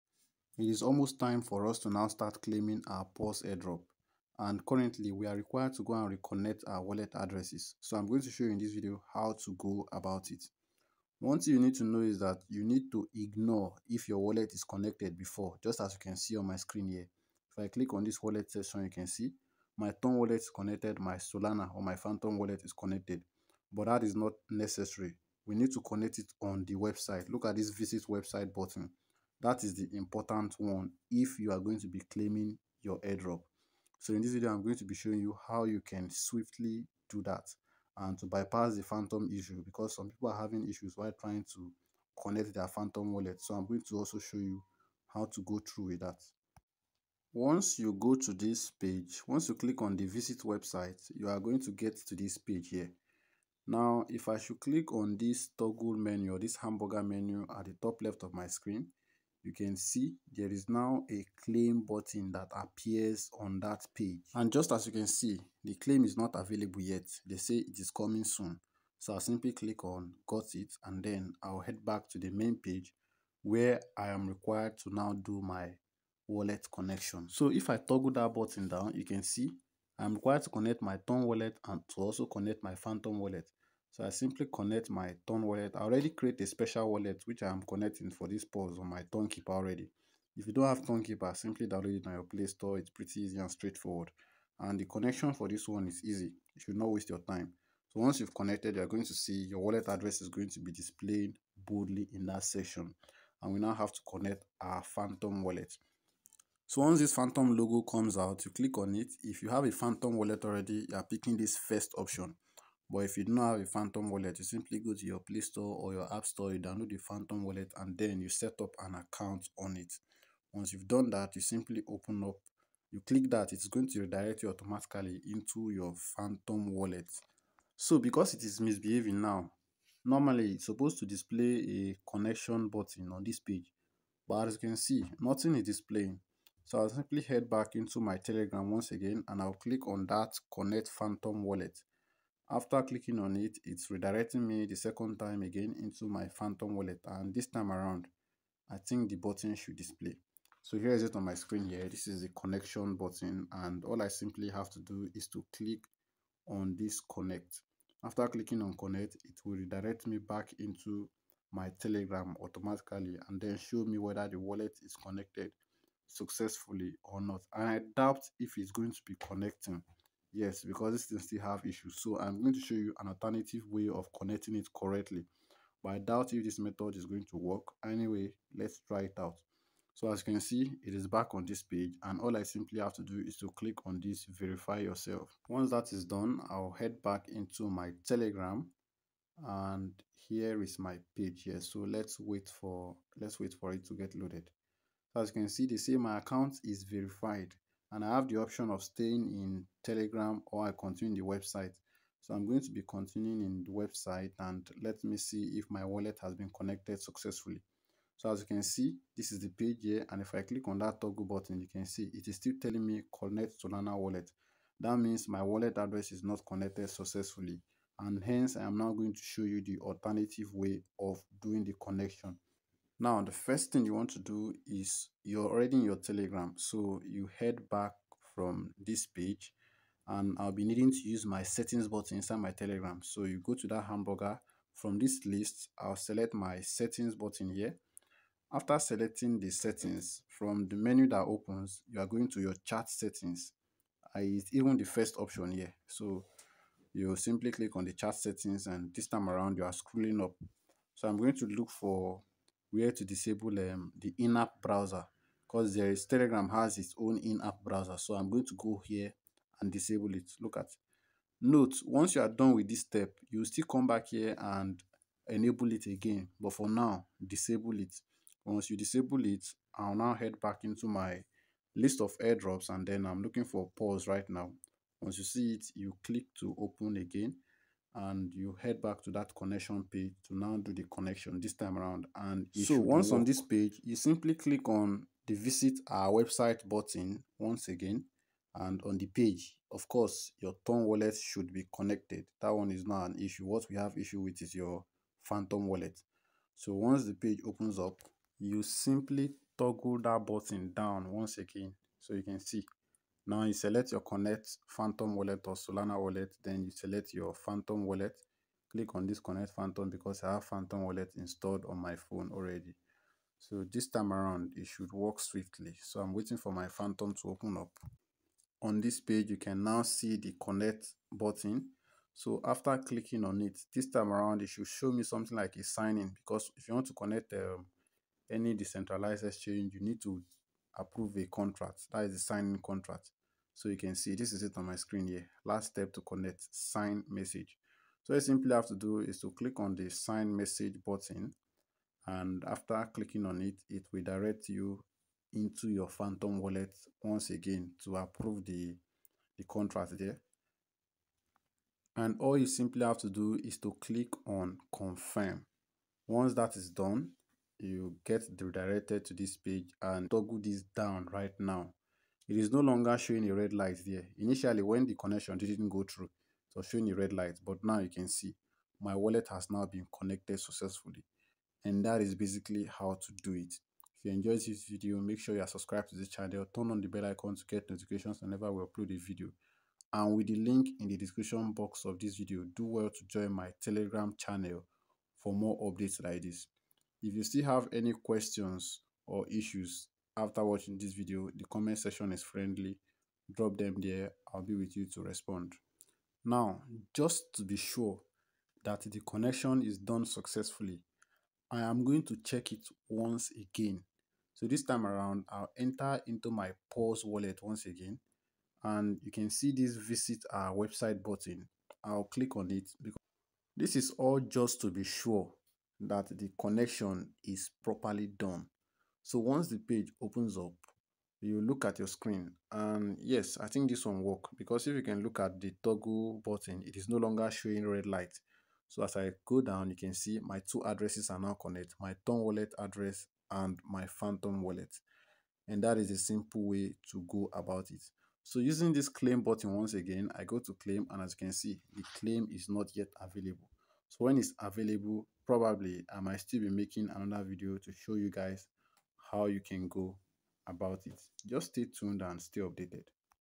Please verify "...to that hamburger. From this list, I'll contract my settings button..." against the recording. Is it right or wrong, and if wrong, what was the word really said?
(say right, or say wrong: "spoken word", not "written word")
wrong: "select", not "contract".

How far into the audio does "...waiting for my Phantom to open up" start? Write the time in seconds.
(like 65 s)
316 s.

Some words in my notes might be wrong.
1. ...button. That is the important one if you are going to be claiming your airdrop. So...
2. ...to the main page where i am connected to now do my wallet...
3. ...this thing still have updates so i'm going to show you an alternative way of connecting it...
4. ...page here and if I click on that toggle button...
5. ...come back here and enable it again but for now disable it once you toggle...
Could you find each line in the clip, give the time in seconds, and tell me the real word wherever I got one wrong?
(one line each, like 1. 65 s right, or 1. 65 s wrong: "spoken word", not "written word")
1. 28 s right
2. 72 s wrong: "required", not "connected"
3. 170 s wrong: "issues", not "updates"
4. 209 s right
5. 263 s wrong: "disable", not "toggle".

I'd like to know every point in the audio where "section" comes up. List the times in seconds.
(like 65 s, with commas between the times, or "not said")
18 s, 102 s, 391 s.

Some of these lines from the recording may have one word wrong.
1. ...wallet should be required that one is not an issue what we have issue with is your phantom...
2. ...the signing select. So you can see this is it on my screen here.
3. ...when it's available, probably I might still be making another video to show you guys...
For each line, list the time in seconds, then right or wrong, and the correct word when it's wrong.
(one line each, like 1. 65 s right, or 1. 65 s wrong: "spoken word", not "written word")
1. 290 s wrong: "connected", not "required"
2. 332 s wrong: "contract", not "select"
3. 444 s right.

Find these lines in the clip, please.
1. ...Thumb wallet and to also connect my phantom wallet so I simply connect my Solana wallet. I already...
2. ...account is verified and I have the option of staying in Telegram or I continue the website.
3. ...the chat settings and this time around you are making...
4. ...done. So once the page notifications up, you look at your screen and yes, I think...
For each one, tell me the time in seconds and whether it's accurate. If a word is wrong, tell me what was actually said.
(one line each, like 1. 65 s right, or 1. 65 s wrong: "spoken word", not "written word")
1. 81 s wrong: "Tone", not "Solana"
2. 196 s right
3. 247 s wrong: "scrolling", not "making"
4. 418 s wrong: "opens", not "notifications".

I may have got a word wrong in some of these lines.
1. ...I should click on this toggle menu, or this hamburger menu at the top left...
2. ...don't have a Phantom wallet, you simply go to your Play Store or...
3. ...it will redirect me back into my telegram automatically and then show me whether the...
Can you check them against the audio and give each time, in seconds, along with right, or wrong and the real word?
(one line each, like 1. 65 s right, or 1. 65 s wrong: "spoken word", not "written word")
1. 54 s right
2. 113 s right
3. 159 s right.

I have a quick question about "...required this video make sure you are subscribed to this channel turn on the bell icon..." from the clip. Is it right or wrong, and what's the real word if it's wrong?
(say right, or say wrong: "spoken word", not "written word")
wrong: "enjoyed", not "required".